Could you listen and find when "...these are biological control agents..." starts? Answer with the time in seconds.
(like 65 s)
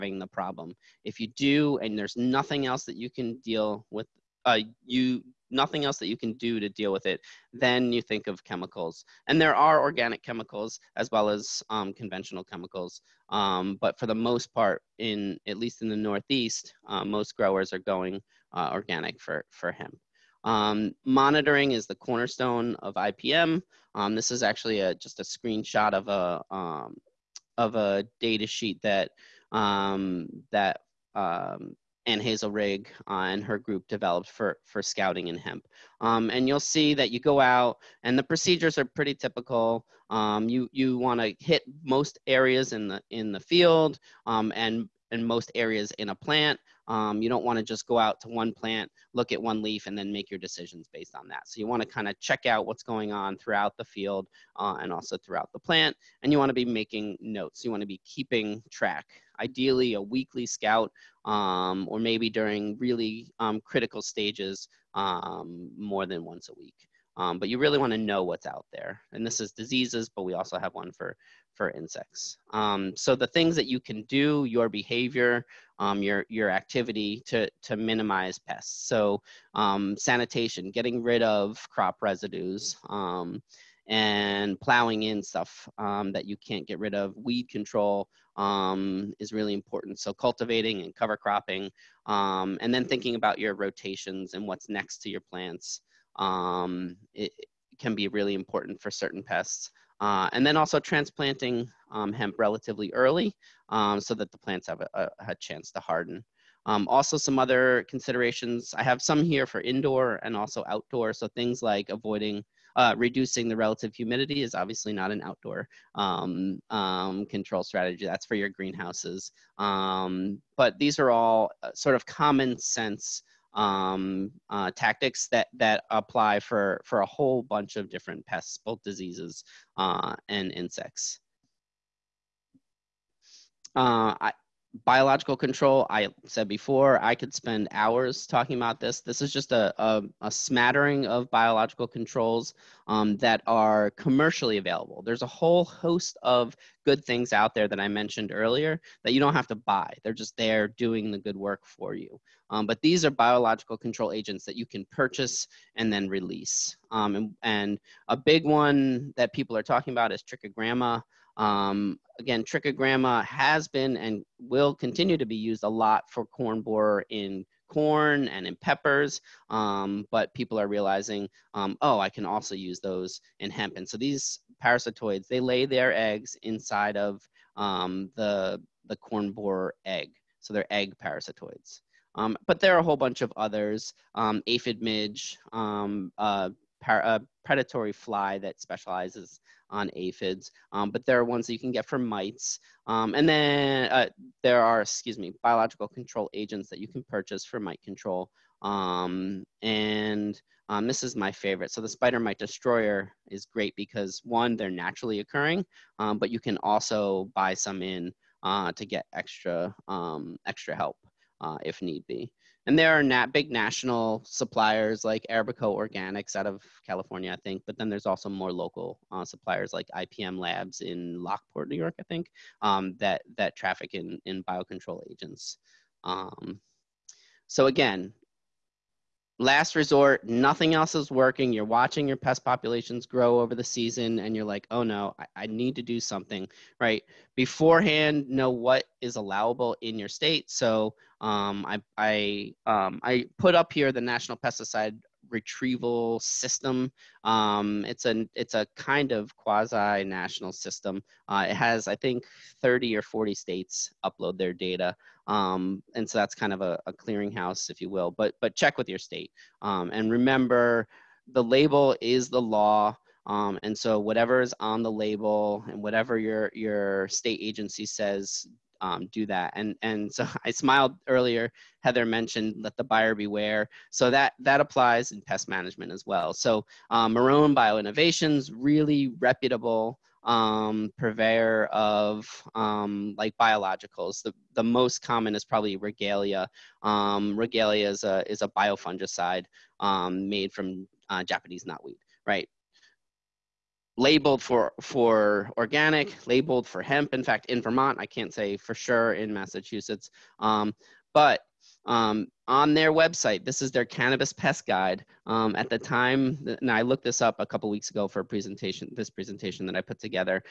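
152 s.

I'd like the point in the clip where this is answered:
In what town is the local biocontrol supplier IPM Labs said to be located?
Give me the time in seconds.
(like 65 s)
221 s.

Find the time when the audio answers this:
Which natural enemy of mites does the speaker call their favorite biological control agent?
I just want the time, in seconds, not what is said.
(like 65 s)
201 s.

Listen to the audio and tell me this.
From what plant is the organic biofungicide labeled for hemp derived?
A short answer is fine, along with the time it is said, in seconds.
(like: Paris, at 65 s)
Japanese knotweed, at 291 s.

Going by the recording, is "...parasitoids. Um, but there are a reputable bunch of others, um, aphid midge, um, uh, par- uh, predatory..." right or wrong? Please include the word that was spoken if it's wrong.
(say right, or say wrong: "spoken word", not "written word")
wrong: "whole", not "reputable".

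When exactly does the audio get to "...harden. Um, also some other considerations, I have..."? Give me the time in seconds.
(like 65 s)
105 s.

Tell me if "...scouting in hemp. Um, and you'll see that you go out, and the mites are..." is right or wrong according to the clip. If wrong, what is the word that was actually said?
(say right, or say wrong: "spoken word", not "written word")
wrong: "procedures", not "mites".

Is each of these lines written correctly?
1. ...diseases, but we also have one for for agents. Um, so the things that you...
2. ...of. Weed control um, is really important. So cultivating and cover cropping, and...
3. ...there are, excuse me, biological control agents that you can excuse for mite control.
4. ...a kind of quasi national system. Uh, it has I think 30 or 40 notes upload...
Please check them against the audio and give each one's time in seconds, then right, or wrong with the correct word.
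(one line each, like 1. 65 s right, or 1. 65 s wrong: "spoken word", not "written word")
1. 69 s wrong: "insects", not "agents"
2. 86 s right
3. 194 s wrong: "purchase", not "excuse"
4. 248 s wrong: "states", not "notes".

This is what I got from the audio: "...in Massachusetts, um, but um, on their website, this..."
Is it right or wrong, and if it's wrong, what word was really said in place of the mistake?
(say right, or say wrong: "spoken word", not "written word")
right.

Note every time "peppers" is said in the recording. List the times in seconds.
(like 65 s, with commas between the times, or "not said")
168 s.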